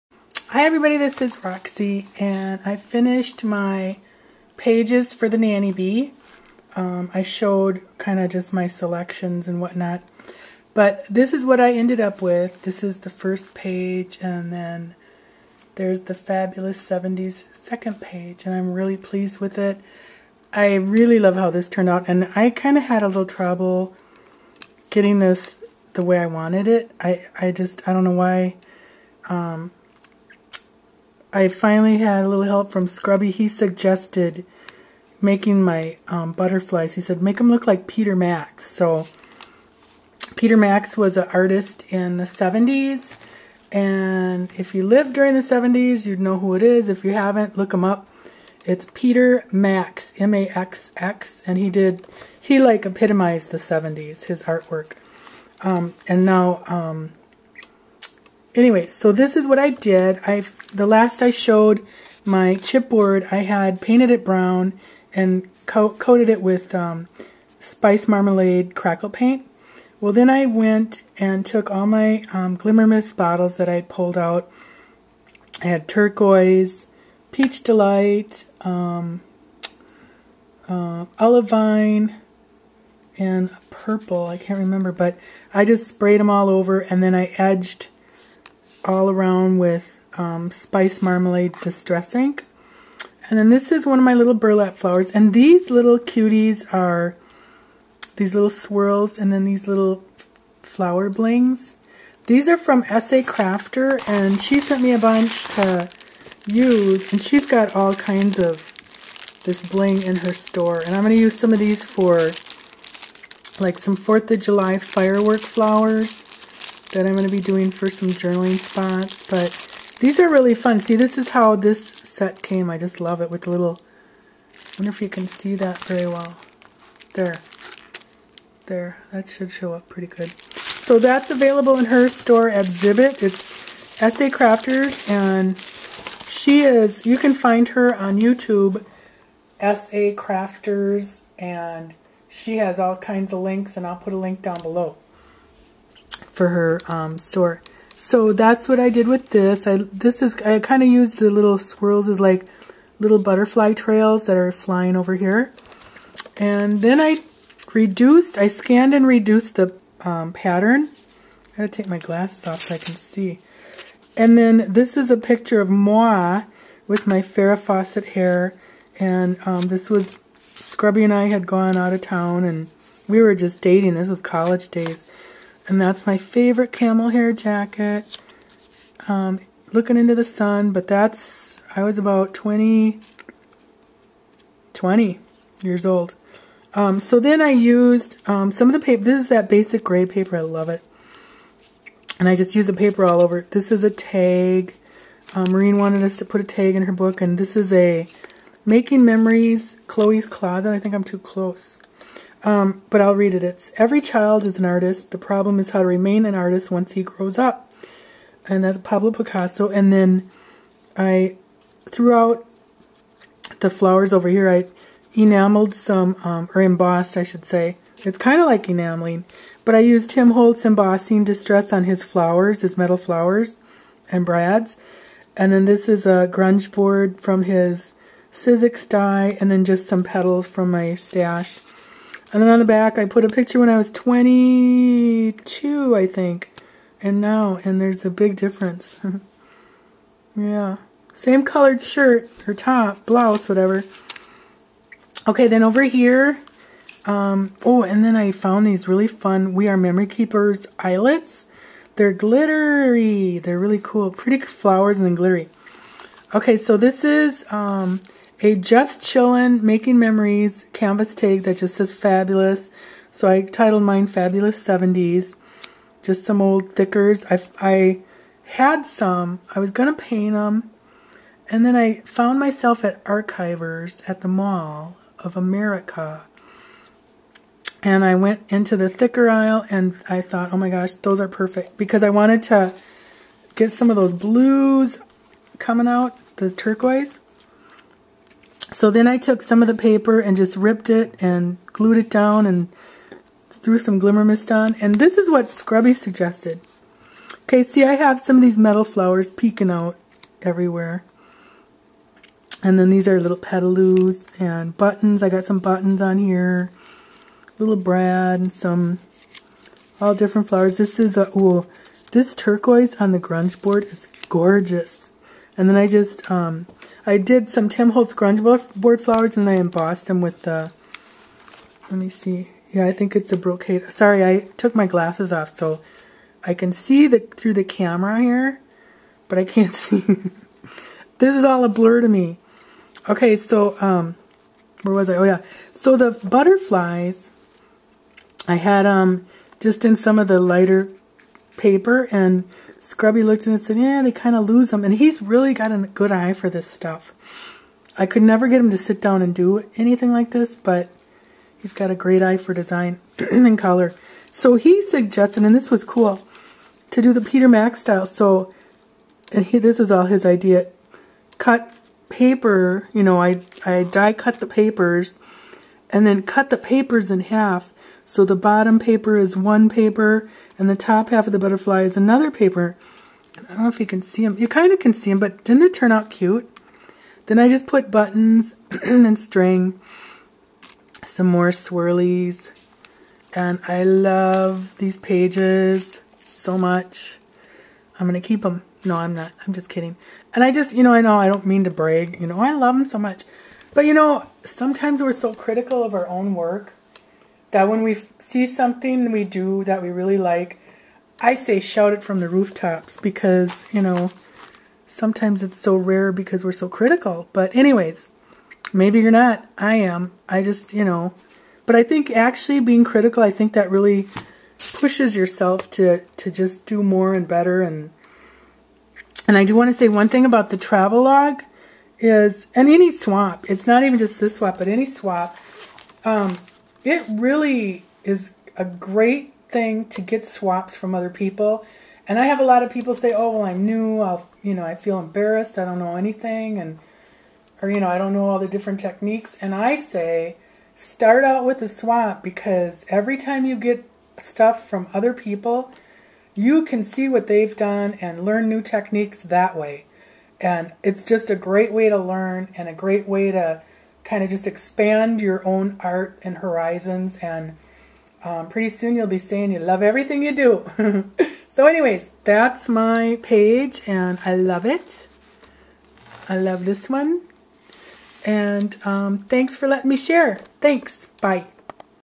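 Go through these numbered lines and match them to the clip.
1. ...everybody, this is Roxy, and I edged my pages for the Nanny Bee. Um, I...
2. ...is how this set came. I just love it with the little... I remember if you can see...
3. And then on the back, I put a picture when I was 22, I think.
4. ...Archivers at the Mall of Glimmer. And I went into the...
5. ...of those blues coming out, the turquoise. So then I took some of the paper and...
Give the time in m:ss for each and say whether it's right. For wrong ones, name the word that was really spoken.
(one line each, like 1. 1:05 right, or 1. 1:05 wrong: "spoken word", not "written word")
1. 0:00 wrong: "finished", not "edged"
2. 2:01 wrong: "wonder", not "remember"
3. 3:52 right
4. 4:33 wrong: "America", not "Glimmer"
5. 4:43 right.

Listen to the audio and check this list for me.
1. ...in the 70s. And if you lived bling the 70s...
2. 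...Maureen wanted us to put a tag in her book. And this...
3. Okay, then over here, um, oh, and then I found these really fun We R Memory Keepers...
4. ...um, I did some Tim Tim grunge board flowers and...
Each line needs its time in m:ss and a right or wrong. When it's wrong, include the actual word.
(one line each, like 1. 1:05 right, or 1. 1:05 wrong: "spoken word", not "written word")
1. 0:41 wrong: "during", not "bling"
2. 3:15 right
3. 4:05 right
4. 5:16 wrong: "Holtz", not "Tim".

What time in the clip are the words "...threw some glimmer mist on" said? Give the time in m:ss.
4:53.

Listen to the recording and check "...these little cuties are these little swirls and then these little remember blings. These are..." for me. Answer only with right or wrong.
wrong.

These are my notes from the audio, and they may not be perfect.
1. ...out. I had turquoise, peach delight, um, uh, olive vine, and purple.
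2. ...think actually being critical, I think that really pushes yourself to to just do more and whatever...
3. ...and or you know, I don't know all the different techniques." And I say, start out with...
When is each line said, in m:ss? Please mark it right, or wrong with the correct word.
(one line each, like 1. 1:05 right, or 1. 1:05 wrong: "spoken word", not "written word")
1. 1:14 right
2. 6:51 wrong: "better", not "whatever"
3. 7:16 right.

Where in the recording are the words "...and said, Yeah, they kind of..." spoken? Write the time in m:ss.
5:43.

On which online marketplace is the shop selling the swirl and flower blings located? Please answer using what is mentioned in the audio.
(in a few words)
Zibbet.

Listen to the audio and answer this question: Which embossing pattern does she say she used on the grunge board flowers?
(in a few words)
brocade.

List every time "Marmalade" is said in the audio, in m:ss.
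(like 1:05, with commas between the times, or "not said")
1:08, 1:31.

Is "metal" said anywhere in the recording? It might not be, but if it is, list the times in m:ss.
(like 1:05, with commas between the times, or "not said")
3:42, 4:58.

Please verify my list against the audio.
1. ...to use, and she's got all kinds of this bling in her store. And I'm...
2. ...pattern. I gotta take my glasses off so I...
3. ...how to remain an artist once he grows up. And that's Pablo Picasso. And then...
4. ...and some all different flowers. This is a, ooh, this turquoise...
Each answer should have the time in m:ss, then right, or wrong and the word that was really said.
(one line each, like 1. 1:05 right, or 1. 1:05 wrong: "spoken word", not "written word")
1. 1:45 right
2. 2:40 right
3. 3:25 right
4. 5:08 right.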